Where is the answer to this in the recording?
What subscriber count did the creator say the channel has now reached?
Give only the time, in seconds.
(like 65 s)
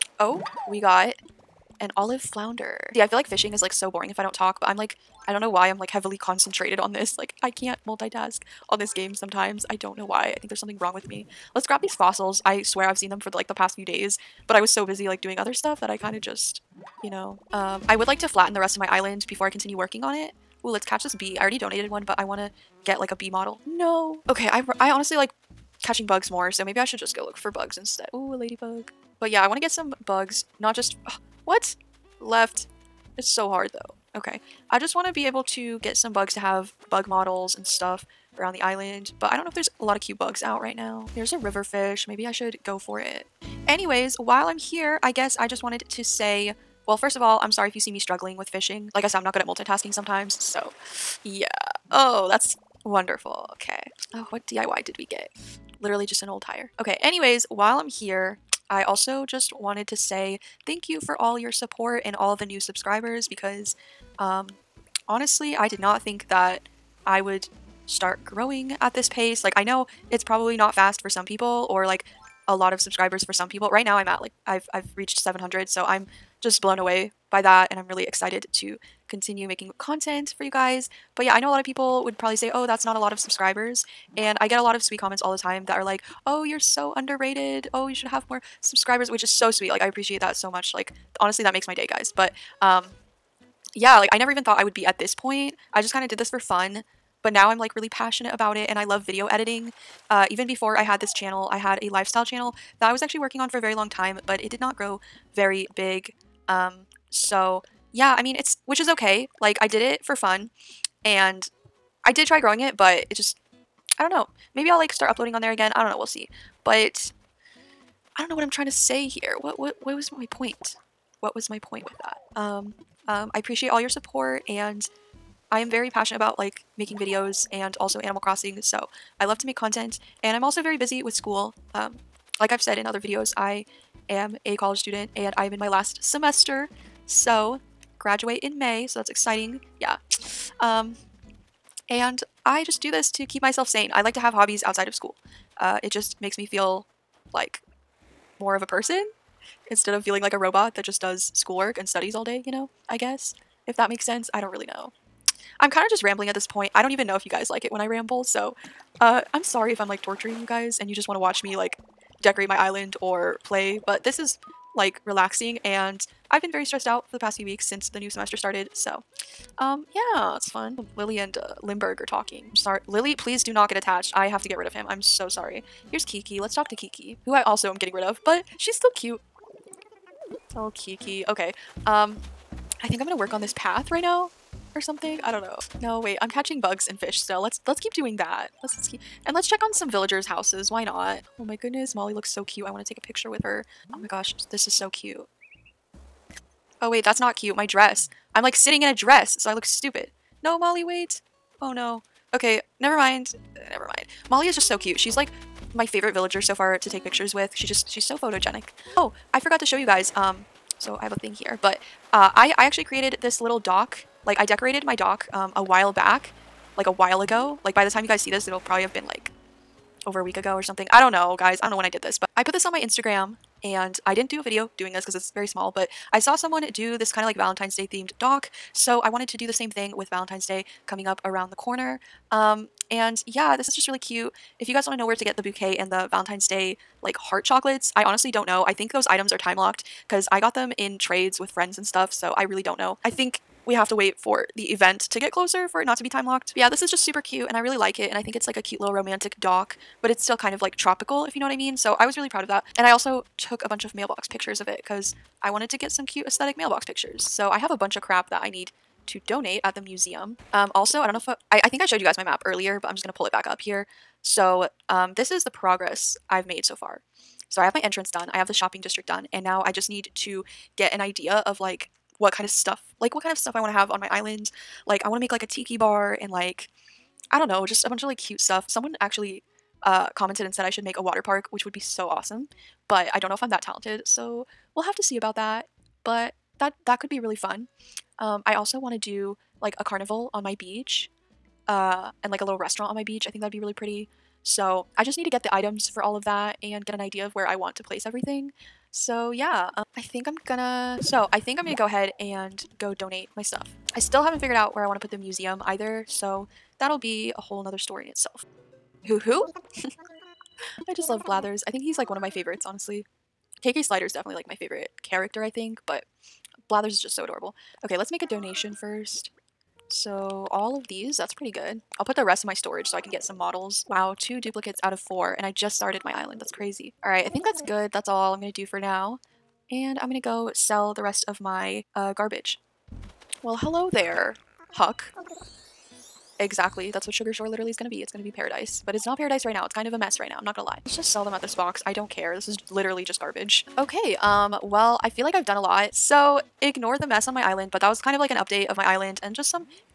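75 s.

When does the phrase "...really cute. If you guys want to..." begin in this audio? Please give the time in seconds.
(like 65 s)
233 s.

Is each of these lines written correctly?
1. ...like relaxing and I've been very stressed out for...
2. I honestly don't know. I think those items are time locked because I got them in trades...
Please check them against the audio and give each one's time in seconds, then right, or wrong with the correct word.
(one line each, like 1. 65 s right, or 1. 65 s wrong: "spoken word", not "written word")
1. 164 s right
2. 237 s right.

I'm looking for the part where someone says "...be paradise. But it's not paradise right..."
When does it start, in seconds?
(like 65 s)
338 s.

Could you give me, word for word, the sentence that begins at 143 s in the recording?
I like to have hobbies outside of school.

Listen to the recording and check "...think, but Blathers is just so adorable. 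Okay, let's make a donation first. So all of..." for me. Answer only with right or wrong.
right.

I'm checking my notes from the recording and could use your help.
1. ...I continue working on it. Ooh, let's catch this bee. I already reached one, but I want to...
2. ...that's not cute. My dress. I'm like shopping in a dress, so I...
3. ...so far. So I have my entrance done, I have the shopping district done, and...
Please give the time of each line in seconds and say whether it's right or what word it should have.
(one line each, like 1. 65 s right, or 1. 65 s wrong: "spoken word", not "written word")
1. 19 s wrong: "donated", not "reached"
2. 197 s wrong: "sitting", not "shopping"
3. 266 s right.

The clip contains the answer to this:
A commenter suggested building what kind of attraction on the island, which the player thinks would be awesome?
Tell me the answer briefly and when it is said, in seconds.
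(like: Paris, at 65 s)
water park, at 281 s.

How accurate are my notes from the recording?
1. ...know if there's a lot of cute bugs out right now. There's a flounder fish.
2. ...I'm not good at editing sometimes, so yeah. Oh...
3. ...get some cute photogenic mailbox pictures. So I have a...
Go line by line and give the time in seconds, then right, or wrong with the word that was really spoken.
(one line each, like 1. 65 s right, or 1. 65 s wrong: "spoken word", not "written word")
1. 39 s wrong: "river", not "flounder"
2. 49 s wrong: "multitasking", not "editing"
3. 255 s wrong: "aesthetic", not "photogenic".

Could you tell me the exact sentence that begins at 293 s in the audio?
I think that'd be really pretty.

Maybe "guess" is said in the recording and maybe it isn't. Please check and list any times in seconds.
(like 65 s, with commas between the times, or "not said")
45 s, 152 s.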